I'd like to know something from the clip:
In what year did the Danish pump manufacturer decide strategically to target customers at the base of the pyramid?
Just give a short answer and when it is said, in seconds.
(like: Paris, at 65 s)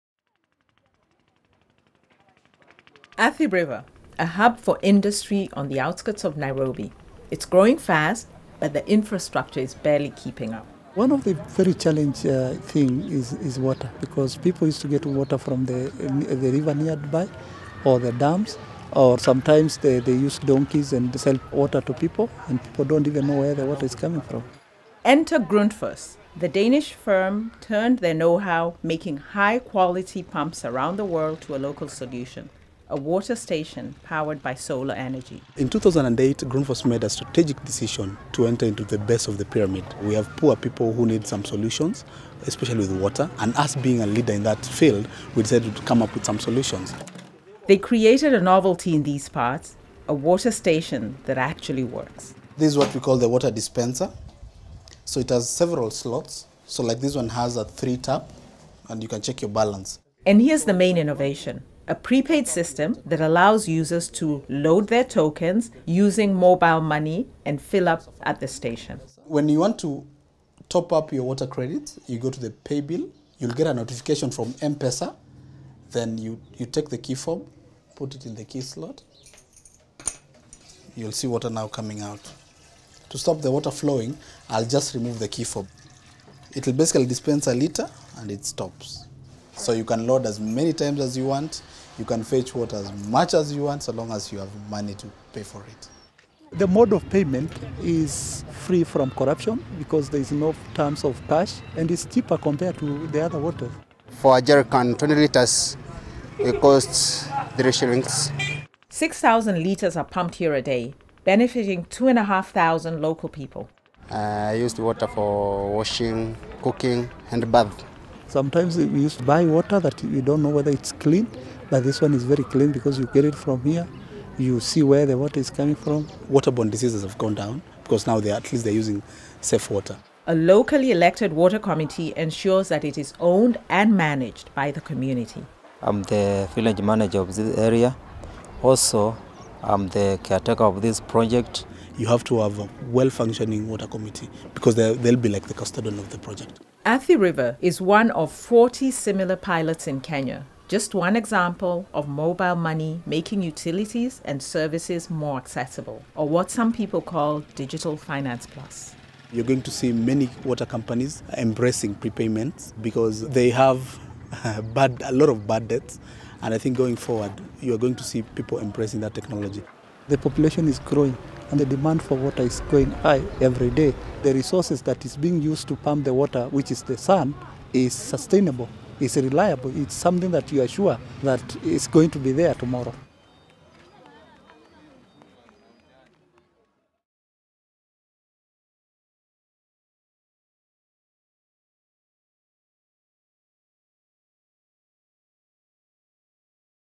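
2008, at 35 s.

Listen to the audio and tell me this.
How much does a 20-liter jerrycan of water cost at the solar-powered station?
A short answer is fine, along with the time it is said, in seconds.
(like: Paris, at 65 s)
3 shillings, at 107 s.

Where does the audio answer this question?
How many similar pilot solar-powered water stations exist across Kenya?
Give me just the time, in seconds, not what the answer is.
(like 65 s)
148 s.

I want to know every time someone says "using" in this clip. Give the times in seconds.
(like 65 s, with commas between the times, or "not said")
65 s, 128 s.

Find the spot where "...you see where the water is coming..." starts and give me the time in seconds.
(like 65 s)
124 s.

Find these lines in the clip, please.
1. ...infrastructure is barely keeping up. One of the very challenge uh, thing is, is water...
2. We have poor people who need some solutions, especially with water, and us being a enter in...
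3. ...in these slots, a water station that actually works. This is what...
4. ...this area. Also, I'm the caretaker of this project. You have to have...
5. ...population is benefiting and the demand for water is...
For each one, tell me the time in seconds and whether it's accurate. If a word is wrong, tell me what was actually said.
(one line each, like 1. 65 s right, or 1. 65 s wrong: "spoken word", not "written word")
1. 8 s right
2. 40 s wrong: "leader", not "enter"
3. 48 s wrong: "parts", not "slots"
4. 137 s right
5. 170 s wrong: "growing", not "benefiting".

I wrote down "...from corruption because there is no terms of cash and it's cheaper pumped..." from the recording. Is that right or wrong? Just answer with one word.
wrong.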